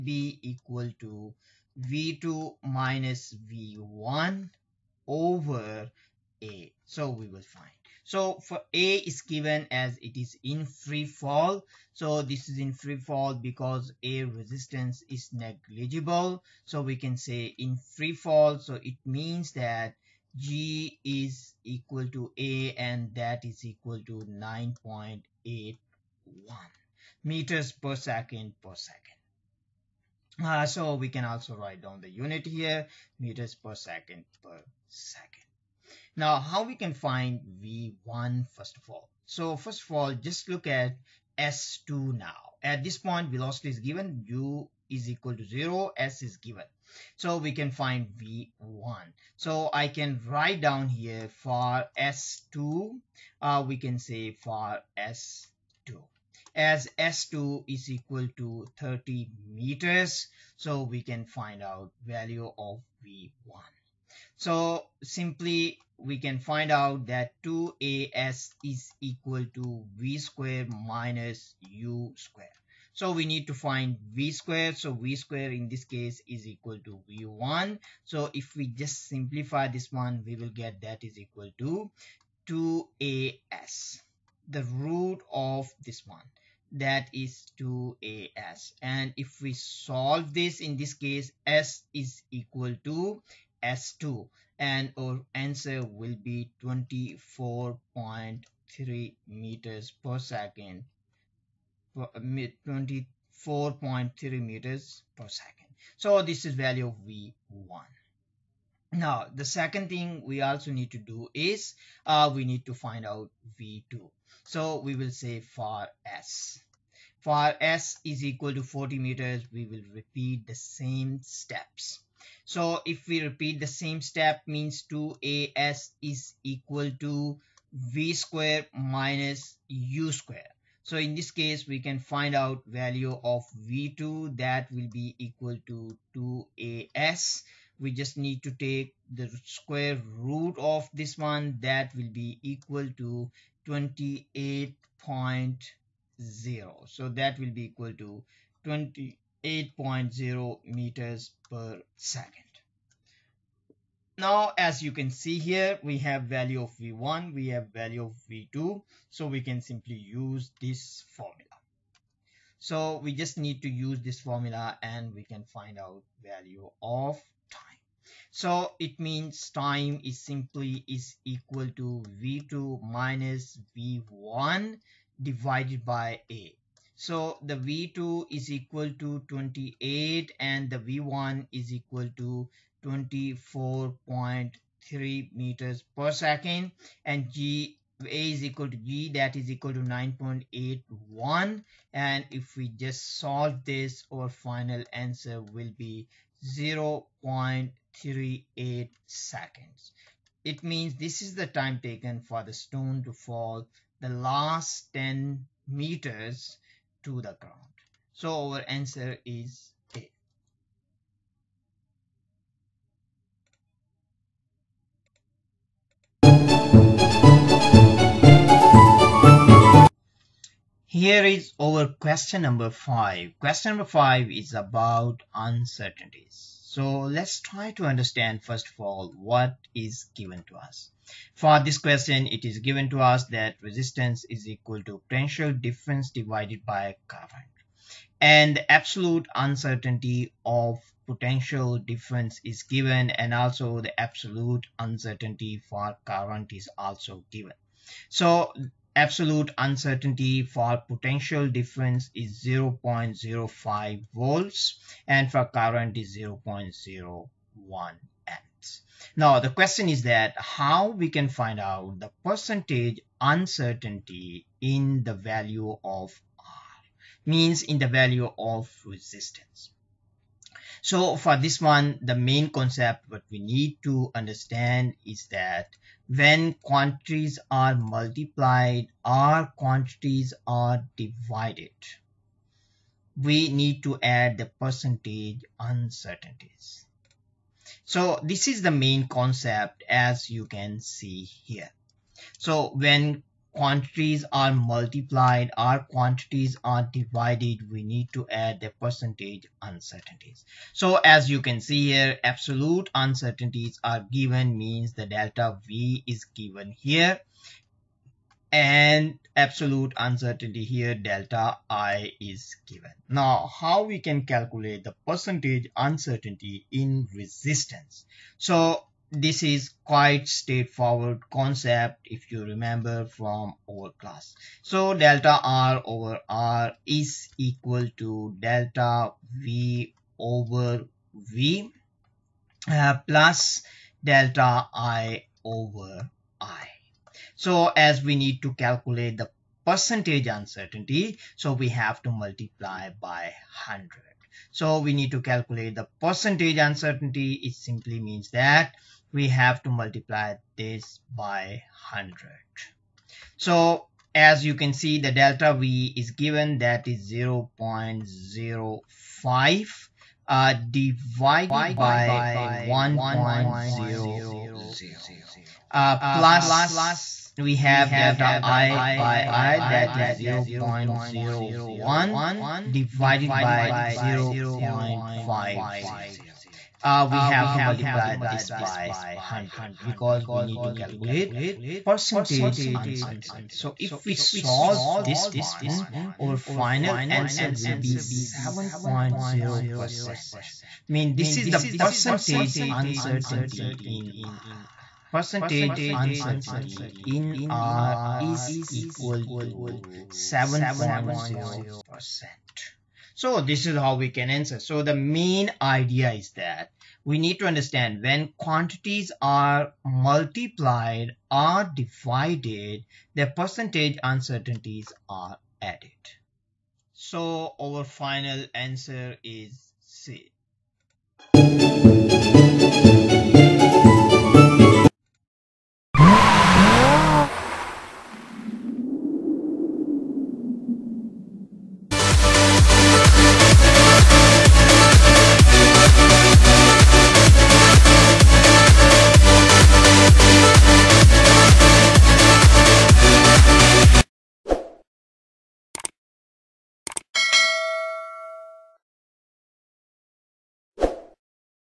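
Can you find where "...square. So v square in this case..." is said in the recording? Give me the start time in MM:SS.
01:14.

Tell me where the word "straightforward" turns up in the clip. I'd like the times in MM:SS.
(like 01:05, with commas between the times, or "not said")
05:20.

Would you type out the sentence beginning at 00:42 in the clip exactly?
At this point, velocity is given, u is equal to zero.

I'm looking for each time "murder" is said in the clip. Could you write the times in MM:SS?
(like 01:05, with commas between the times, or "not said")
not said.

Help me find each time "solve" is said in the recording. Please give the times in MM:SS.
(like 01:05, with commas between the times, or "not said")
01:29, 03:13, 06:24.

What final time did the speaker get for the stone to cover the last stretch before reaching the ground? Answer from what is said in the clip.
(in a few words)
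0.38 seconds.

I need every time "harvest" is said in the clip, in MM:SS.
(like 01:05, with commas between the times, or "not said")
not said.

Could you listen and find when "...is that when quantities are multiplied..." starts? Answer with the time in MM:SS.
04:35.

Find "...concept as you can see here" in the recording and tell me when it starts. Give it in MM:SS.
04:49.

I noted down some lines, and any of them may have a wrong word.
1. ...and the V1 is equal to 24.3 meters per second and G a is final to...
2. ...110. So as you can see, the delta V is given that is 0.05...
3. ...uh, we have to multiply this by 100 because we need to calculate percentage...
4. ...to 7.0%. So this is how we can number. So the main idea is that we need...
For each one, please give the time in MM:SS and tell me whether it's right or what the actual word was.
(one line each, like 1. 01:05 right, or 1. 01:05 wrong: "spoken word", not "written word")
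1. 03:00 wrong: "equal", not "final"
2. 05:51 wrong: "100", not "110"
3. 06:16 right
4. 06:39 wrong: "answer", not "number".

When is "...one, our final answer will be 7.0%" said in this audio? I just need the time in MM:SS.
06:25.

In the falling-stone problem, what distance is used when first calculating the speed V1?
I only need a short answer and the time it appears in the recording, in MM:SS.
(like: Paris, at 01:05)
30 meters, at 00:58.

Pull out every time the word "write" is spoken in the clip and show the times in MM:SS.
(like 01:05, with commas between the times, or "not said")
00:31, 00:50.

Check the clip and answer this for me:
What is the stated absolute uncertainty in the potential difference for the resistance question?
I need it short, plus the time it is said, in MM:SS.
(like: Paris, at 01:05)
0.05 volts, at 04:12.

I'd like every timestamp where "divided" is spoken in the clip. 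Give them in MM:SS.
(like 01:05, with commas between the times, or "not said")
02:55, 03:56, 04:40, 04:56, 06:00, 06:12, 06:51.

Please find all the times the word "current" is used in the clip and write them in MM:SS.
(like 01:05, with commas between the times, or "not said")
03:57, 04:06, 04:15.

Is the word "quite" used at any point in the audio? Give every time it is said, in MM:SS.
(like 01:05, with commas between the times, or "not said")
05:19.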